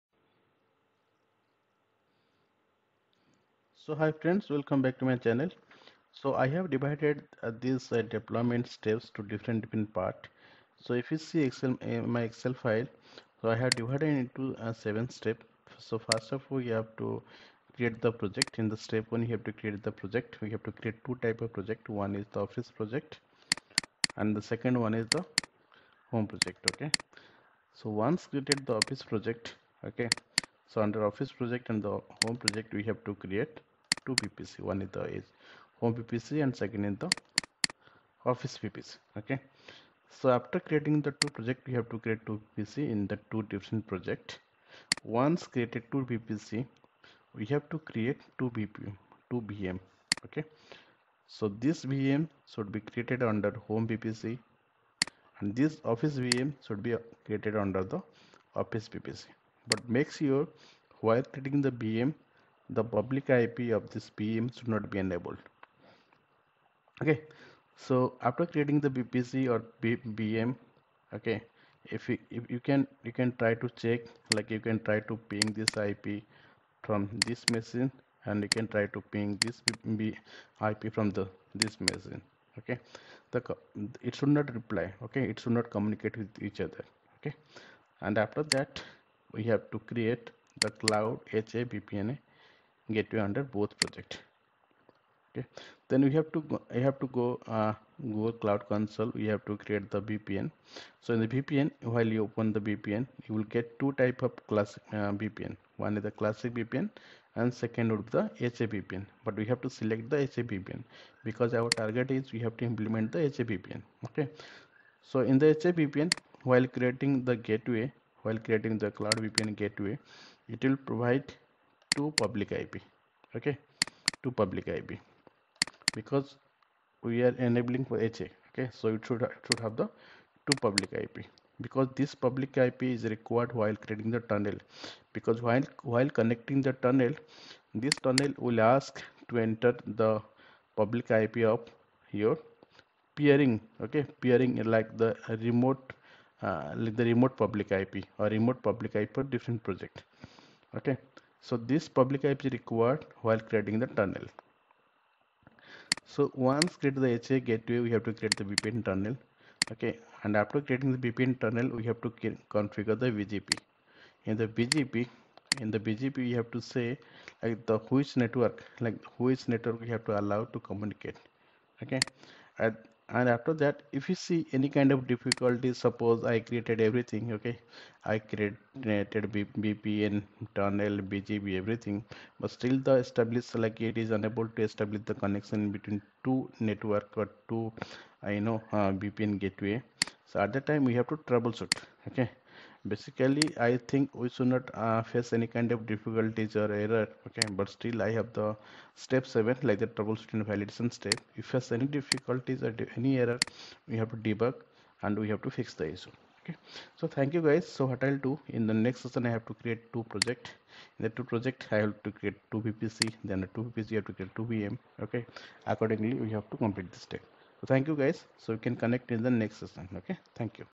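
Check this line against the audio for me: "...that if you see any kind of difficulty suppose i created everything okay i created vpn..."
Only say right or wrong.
right.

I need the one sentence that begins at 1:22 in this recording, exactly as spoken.
Okay, the it should not reply.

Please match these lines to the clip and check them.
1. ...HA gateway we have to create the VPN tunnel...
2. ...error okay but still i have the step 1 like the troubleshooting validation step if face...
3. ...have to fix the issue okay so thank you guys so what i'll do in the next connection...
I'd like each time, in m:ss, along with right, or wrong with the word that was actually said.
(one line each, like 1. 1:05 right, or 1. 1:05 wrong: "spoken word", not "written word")
1. 2:37 right
2. 3:16 wrong: "7", not "1"
3. 3:25 wrong: "session", not "connection".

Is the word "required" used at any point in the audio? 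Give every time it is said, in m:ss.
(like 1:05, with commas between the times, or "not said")
2:13, 2:32.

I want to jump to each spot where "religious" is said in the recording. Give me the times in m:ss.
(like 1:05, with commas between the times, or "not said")
not said.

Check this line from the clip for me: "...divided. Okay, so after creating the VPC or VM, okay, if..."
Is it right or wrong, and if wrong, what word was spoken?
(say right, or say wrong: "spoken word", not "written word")
wrong: "enabled", not "divided".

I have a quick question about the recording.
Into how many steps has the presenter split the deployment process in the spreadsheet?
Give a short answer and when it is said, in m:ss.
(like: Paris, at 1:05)
7, at 0:14.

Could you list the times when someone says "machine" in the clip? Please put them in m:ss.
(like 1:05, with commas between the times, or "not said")
1:17, 1:21.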